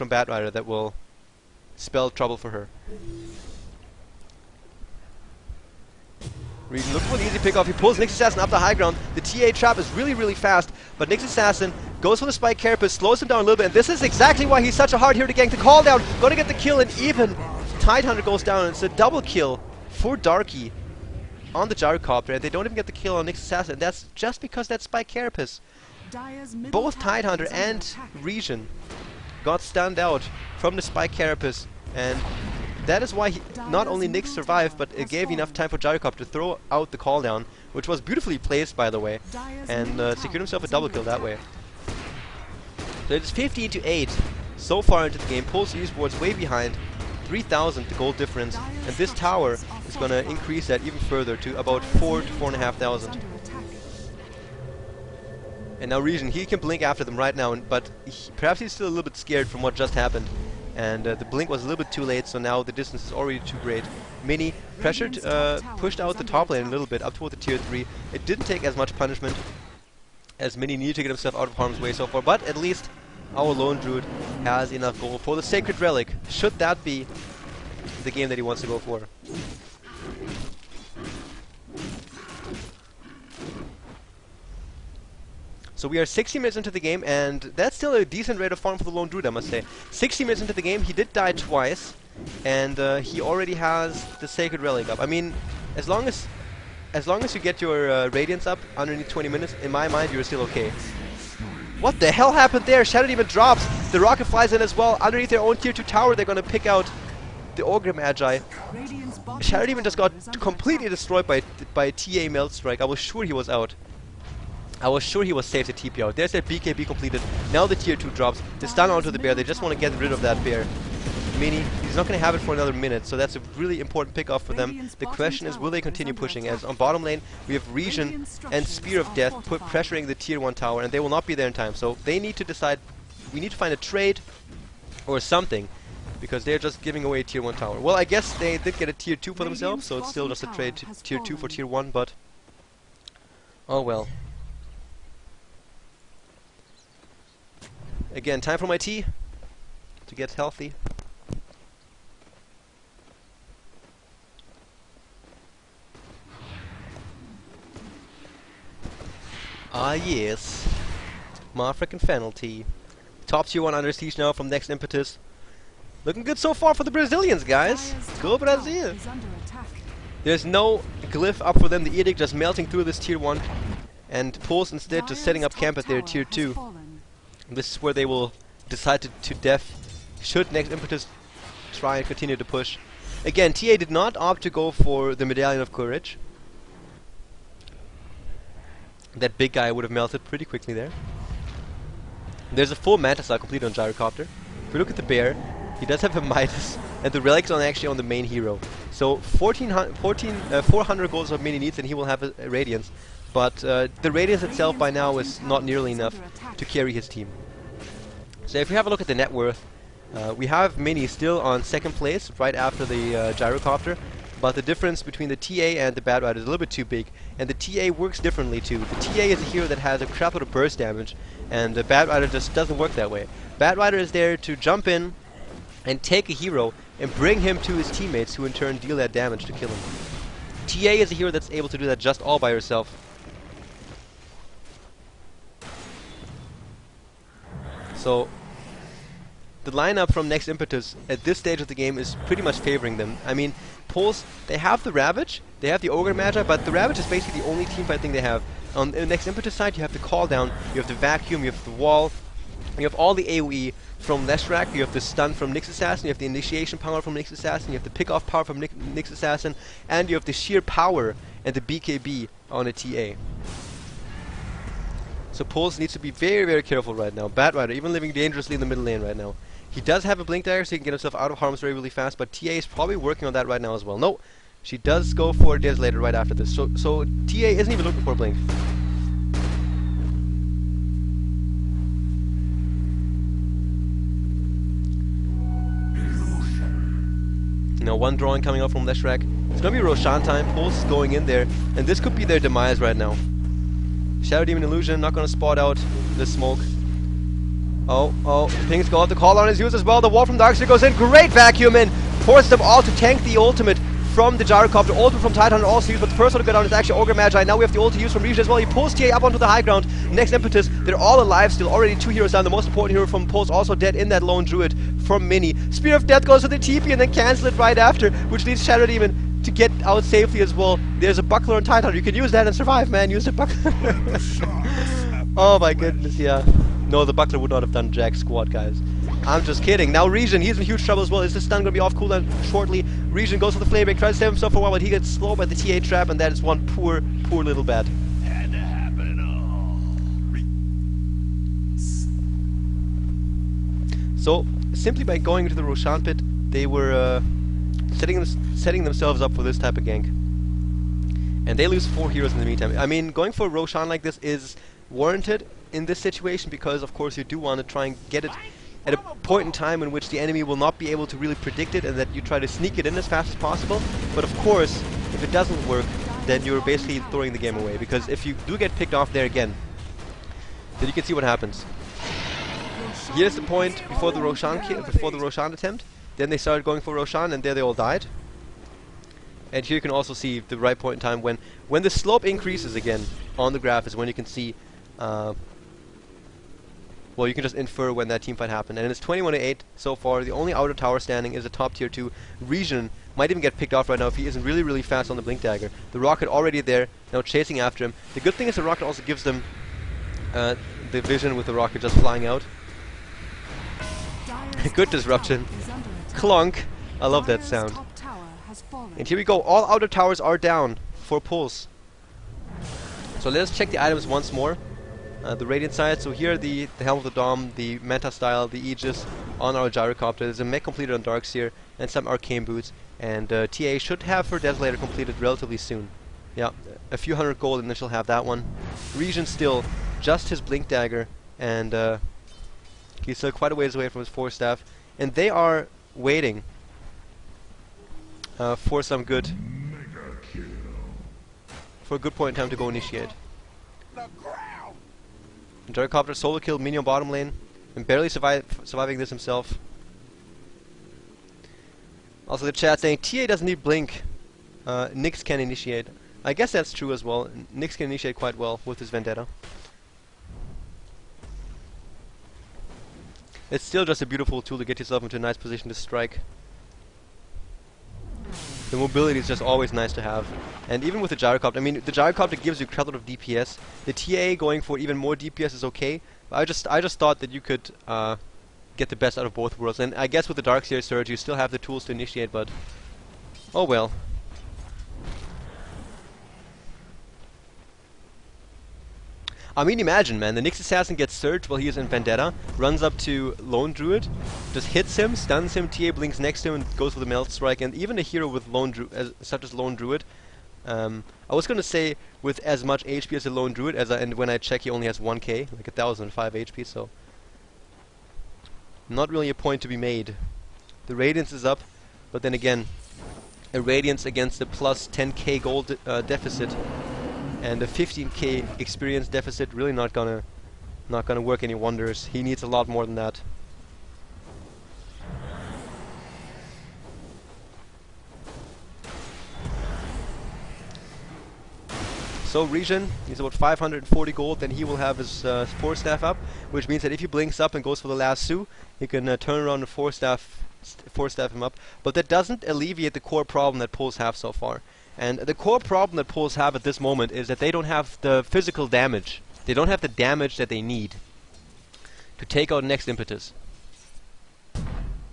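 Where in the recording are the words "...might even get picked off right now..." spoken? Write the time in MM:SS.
06:33.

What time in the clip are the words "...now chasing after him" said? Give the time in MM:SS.
06:37.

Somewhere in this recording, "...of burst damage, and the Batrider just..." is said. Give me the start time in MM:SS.
03:40.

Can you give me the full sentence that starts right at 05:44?
So, simply by going into the Roshan pit, they were uh, setting, them, setting themselves up for this type of gank.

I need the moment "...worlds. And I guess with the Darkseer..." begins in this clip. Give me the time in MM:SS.
07:59.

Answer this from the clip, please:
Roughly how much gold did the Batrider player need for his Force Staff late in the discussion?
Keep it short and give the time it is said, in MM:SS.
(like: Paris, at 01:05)
540 gold, at 08:53.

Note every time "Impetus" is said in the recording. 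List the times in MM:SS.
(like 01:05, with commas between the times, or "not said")
02:44, 03:00, 04:00, 04:09, 05:10, 09:12.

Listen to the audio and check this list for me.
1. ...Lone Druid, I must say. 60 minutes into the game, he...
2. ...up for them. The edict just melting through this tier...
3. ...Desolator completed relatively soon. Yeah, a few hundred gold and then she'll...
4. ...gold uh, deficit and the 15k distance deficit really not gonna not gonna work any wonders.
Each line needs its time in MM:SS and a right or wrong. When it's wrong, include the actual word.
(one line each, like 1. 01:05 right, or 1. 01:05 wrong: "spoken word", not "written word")
1. 01:28 right
2. 02:51 right
3. 07:04 right
4. 08:35 wrong: "experience", not "distance".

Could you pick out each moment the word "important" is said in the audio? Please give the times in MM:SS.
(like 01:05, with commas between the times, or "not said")
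02:03, 05:12.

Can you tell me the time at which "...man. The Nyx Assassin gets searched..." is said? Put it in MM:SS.
08:10.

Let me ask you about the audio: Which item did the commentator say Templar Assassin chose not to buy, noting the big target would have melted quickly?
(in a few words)
Medallion of Courage.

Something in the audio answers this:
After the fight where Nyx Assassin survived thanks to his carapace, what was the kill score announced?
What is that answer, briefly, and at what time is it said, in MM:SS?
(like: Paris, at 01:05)
15 to 8, at 00:43.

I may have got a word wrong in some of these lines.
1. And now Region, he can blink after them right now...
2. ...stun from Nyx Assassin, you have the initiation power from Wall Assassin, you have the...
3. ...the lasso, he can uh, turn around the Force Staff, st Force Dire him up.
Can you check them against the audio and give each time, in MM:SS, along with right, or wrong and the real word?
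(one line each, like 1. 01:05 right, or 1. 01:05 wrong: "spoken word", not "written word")
1. 00:55 right
2. 04:15 wrong: "Nyx", not "Wall"
3. 08:57 wrong: "Staff", not "Dire".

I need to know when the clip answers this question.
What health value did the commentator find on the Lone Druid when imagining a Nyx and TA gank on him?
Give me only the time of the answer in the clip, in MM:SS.
08:25.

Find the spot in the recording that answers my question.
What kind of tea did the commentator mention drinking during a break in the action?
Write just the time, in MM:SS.
02:42.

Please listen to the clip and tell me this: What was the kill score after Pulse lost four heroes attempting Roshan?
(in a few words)
21 8.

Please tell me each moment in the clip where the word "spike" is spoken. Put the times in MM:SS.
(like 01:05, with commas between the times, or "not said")
00:12, 00:24, 00:30.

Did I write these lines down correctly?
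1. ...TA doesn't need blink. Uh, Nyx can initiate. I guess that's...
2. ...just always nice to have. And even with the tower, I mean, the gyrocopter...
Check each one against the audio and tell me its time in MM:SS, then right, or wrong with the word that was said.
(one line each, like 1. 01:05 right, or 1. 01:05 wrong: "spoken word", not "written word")
1. 07:32 right
2. 07:49 wrong: "gyrocopter", not "tower".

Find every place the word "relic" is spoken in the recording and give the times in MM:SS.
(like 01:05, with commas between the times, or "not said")
01:15, 01:34, 03:17.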